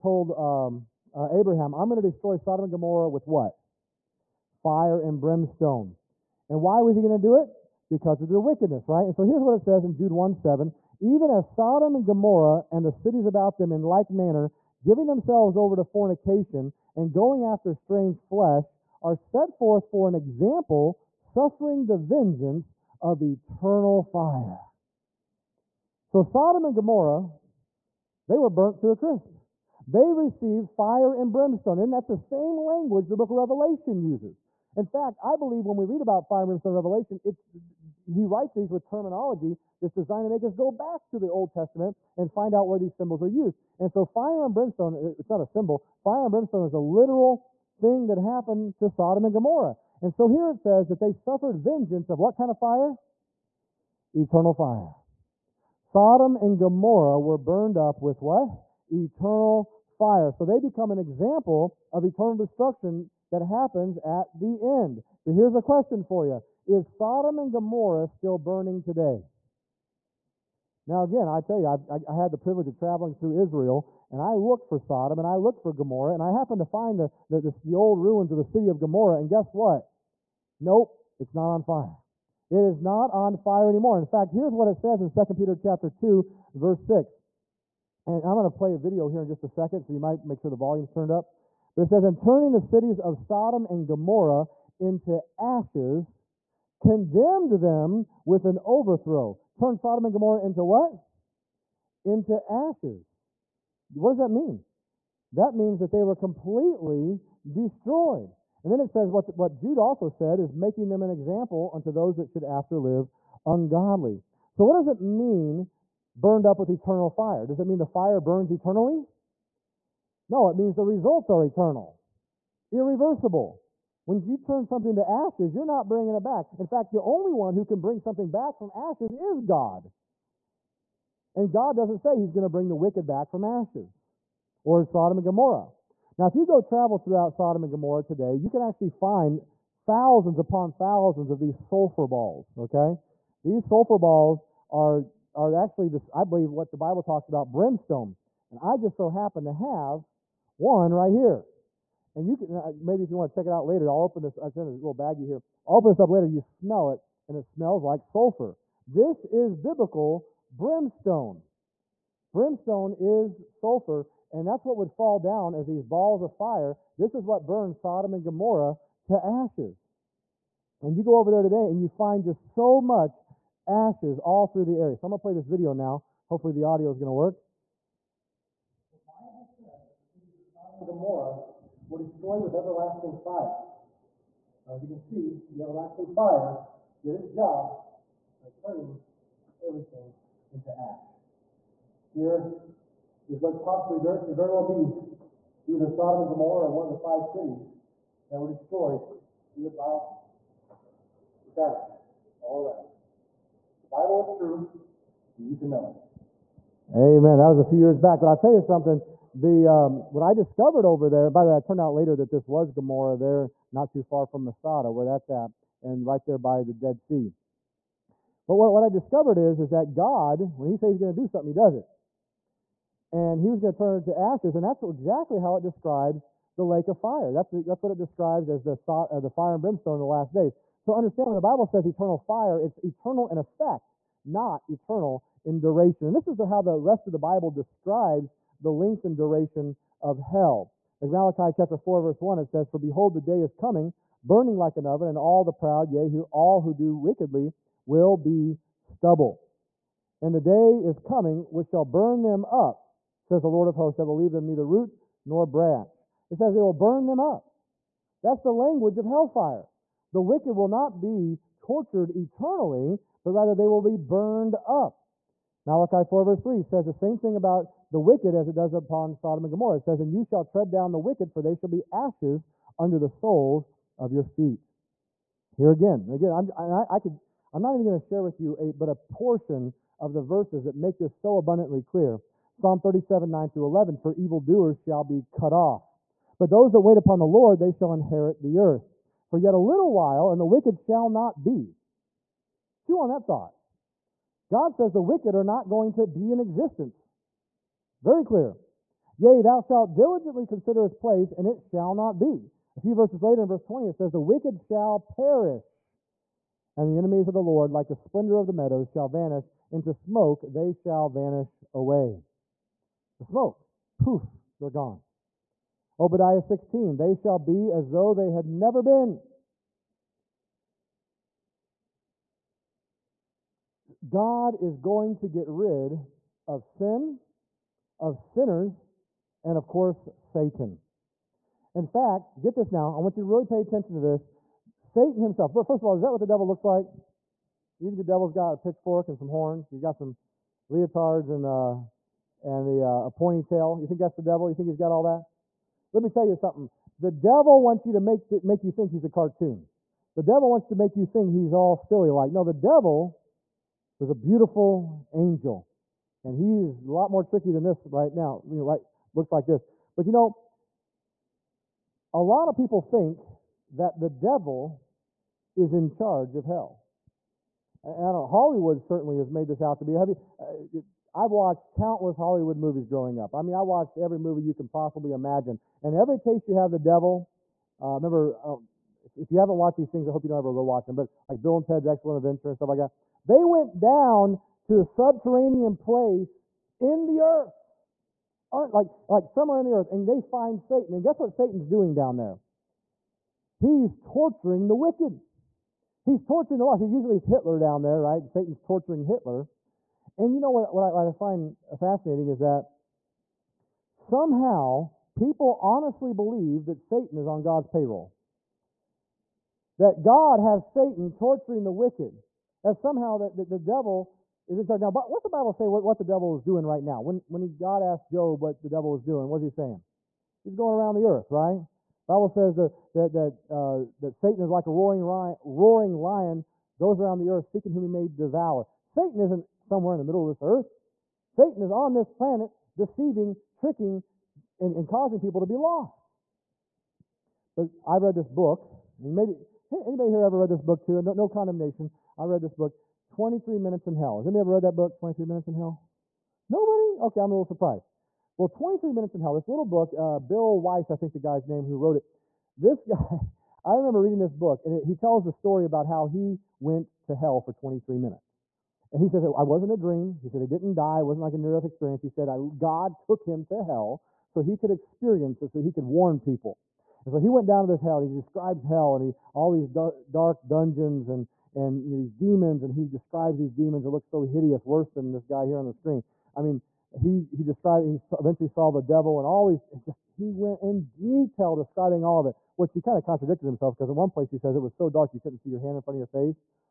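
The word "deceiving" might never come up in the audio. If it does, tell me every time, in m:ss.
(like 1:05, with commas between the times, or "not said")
7:12.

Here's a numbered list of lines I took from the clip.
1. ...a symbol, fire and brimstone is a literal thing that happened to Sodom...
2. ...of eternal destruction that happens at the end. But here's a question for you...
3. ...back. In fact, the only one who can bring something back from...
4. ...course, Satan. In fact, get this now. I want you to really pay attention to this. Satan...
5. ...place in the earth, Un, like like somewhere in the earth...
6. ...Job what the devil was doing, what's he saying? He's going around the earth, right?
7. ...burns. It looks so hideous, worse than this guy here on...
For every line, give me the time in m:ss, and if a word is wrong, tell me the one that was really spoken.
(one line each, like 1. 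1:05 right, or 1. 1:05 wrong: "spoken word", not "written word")
1. 0:45 right
2. 1:01 right
3. 2:06 right
4. 5:29 right
5. 6:25 right
6. 6:58 right
7. 7:53 wrong: "demons", not "burns".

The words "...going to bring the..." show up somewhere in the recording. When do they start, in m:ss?
2:12.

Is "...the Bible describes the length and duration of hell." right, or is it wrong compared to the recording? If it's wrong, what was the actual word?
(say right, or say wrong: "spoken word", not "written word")
right.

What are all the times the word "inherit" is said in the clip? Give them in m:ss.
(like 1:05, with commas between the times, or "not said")
4:47.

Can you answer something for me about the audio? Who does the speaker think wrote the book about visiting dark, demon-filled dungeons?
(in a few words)
Bill Wiese.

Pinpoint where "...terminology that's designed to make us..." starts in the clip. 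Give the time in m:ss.
0:38.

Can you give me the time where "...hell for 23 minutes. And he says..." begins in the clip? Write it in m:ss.
7:37.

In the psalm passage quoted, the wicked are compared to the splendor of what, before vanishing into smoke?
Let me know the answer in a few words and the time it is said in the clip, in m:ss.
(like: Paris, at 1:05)
the meadows, at 5:08.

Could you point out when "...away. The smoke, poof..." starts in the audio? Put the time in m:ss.
5:11.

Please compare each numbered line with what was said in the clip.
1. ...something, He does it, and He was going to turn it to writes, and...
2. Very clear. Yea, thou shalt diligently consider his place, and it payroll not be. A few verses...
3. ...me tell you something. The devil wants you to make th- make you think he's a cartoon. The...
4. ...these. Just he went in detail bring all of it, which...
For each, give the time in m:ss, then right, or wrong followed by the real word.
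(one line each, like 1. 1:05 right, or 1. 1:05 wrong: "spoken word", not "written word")
1. 3:41 wrong: "ashes", not "writes"
2. 4:58 wrong: "shall", not "payroll"
3. 5:46 right
4. 7:59 wrong: "describing", not "bring".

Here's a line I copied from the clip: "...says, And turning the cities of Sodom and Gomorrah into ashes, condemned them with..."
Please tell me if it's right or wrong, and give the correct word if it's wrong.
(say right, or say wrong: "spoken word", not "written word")
right.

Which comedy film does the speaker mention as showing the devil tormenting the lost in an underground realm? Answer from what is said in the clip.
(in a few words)
Bill and Ted's Excellent Adventure.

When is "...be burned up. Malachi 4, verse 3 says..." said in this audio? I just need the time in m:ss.
4:23.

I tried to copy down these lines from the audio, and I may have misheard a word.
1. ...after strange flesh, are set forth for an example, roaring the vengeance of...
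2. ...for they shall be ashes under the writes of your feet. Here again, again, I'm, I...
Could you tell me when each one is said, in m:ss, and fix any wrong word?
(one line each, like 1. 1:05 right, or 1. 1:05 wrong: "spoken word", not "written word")
1. 0:17 wrong: "suffering", not "roaring"
2. 4:31 wrong: "soles", not "writes".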